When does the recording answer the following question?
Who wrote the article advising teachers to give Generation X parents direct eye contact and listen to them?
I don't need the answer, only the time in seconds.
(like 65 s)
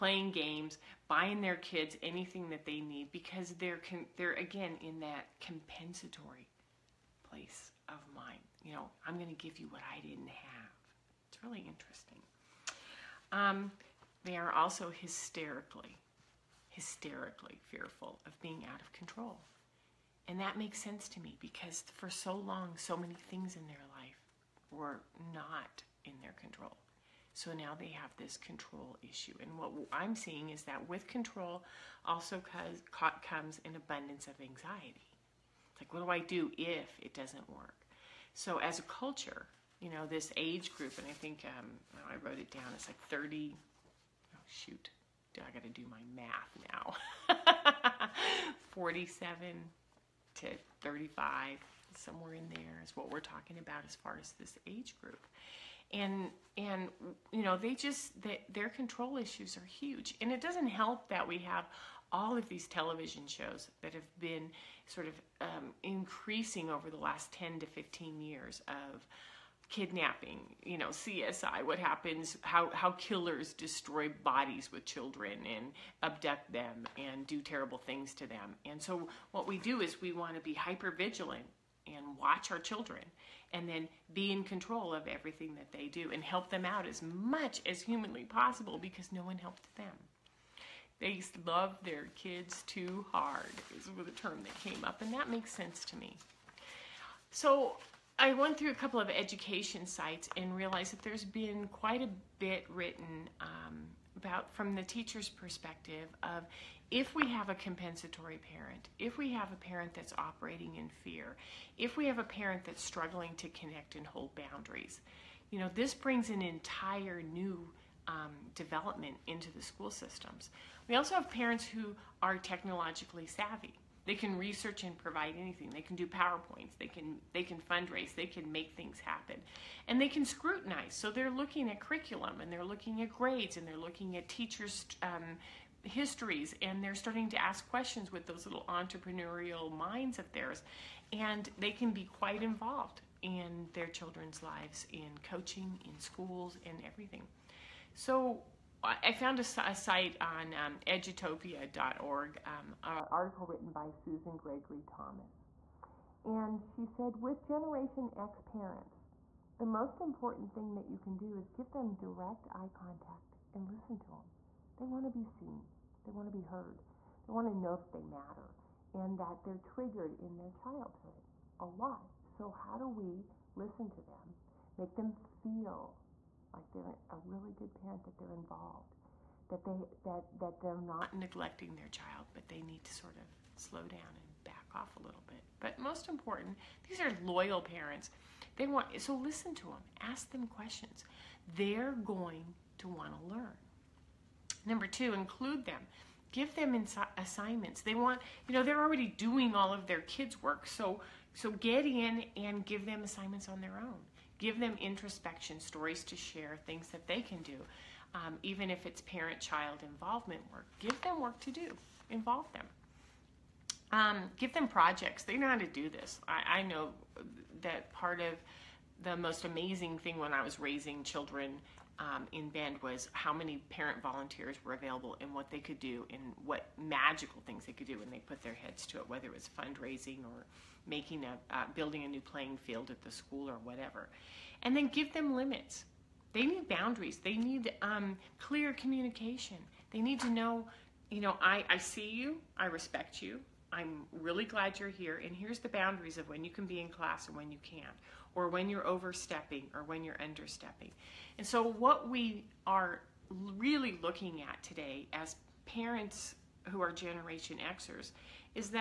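153 s.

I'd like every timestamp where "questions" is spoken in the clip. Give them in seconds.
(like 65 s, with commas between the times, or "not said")
137 s, 190 s.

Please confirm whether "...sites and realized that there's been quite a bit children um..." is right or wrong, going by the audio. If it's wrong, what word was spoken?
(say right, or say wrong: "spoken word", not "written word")
wrong: "written", not "children".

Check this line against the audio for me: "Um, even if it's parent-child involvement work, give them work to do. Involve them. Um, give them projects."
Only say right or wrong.
right.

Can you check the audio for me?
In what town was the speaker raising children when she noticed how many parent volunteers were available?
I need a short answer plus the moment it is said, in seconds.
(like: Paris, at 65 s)
Bend, at 222 s.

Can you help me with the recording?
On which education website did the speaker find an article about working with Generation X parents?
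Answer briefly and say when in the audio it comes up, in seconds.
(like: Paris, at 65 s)
edutopia.org, at 150 s.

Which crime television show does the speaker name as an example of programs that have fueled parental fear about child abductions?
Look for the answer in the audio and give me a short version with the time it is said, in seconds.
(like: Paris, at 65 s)
CSI, at 70 s.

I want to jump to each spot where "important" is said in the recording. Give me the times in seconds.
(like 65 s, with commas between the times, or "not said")
160 s, 186 s.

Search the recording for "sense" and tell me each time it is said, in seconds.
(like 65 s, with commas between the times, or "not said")
20 s, 95 s.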